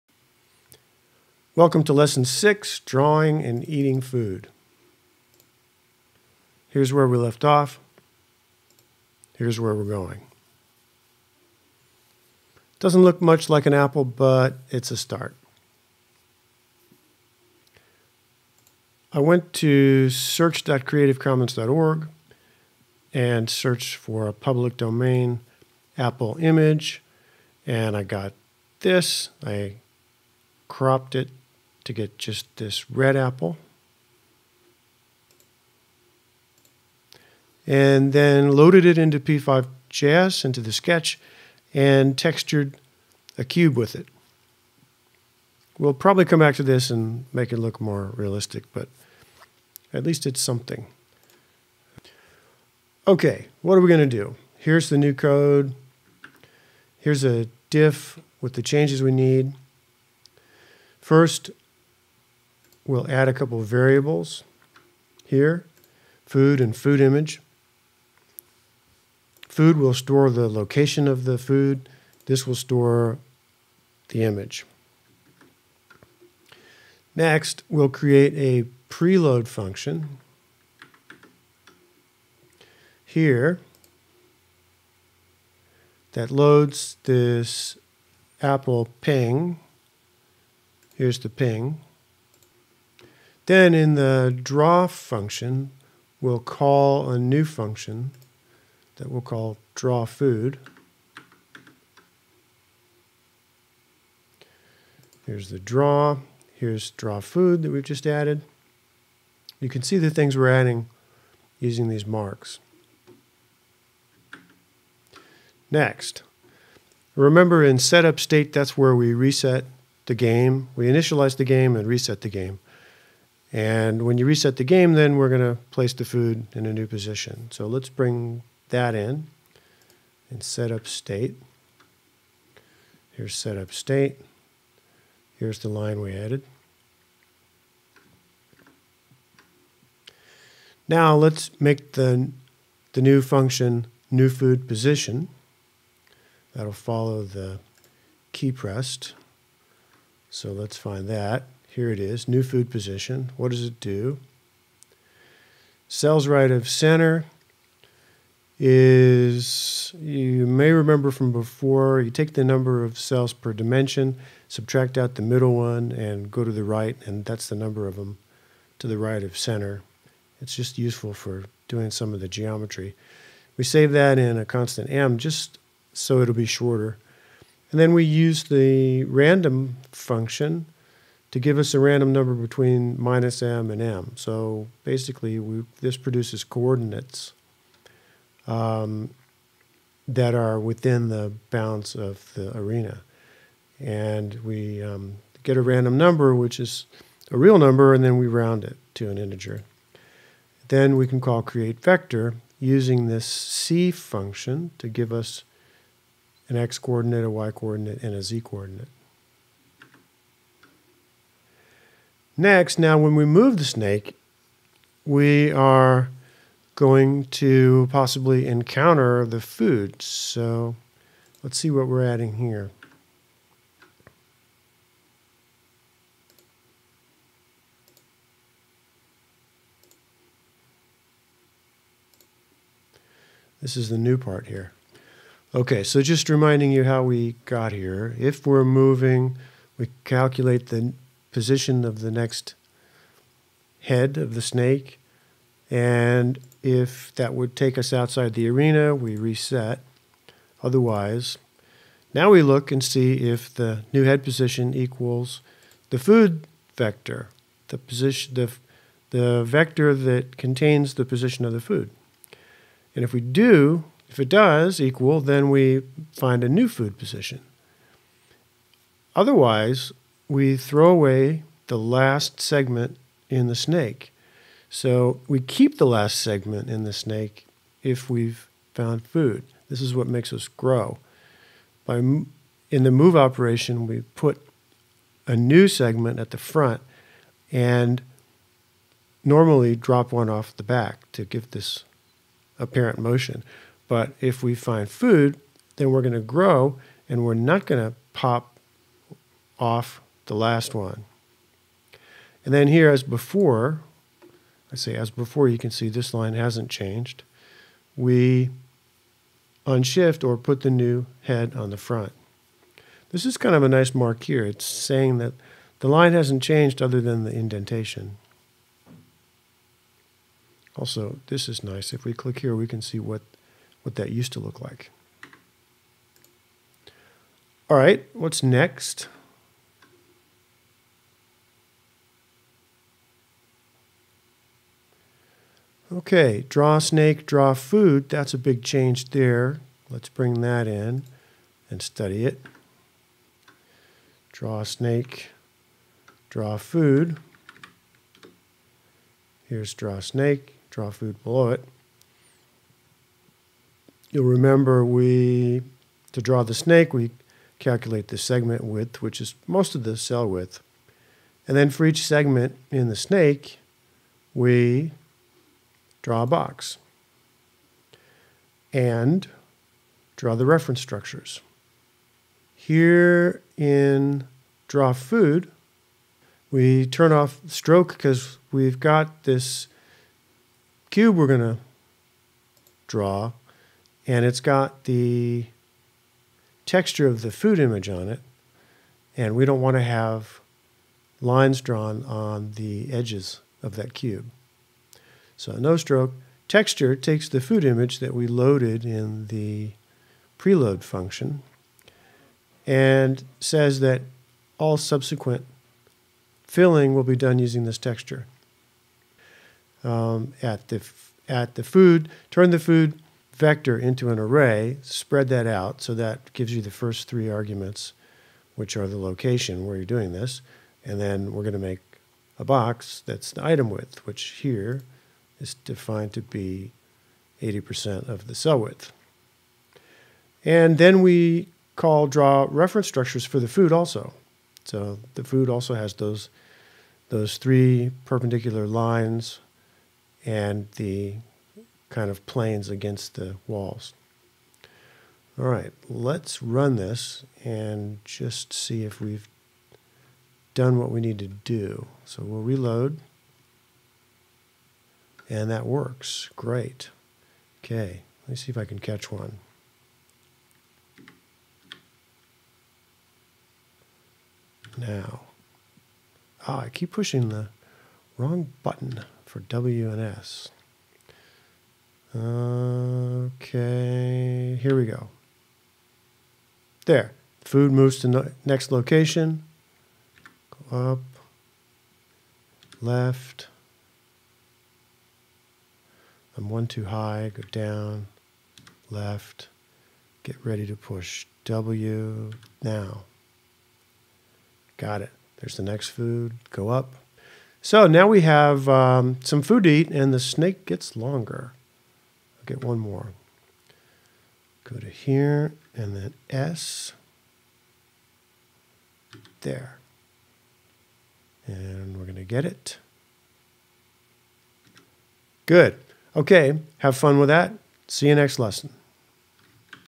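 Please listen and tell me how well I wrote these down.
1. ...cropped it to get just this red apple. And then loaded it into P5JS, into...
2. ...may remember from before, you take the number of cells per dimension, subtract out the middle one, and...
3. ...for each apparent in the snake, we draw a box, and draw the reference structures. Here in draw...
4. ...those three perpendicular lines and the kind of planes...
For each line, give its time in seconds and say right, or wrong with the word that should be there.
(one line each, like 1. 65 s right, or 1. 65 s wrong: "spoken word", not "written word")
1. 30 s right
2. 160 s right
3. 361 s wrong: "segment", not "apparent"
4. 437 s right.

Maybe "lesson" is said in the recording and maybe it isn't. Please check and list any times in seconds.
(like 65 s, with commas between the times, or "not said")
1 s, 518 s.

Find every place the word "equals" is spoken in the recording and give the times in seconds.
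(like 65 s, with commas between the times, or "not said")
254 s, 264 s.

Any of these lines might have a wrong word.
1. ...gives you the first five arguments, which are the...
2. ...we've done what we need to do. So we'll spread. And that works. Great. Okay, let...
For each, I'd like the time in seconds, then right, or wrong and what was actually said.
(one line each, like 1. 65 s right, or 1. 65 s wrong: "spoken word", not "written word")
1. 416 s wrong: "three", not "five"
2. 449 s wrong: "reload", not "spread".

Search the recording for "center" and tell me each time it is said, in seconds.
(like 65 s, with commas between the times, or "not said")
156 s, 169 s.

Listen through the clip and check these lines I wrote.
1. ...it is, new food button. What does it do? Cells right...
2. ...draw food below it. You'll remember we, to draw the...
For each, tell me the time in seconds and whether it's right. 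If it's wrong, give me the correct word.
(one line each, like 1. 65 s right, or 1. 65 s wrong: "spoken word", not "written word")
1. 151 s wrong: "position", not "button"
2. 350 s right.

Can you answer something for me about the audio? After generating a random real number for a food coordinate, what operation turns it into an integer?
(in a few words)
round.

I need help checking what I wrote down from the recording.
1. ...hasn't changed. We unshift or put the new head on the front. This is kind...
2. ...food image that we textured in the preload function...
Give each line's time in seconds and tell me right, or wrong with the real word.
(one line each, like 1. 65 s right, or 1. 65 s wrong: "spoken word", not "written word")
1. 306 s right
2. 397 s wrong: "loaded", not "textured".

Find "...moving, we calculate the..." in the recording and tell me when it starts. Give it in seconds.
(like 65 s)
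238 s.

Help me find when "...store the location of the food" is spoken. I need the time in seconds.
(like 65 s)
69 s.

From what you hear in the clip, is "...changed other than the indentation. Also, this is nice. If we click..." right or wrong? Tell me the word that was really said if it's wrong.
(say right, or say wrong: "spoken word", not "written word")
right.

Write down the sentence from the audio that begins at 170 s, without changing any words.
It's just useful for doing some of the geometry.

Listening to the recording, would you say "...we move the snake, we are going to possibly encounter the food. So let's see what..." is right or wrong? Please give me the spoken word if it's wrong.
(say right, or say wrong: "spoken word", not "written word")
right.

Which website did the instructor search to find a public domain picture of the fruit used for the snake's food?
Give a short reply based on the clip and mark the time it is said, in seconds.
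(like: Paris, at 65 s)
search.creativecommons.org, at 20 s.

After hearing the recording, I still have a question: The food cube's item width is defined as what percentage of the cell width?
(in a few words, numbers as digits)
80%.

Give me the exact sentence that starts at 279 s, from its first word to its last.
This is what makes us grow.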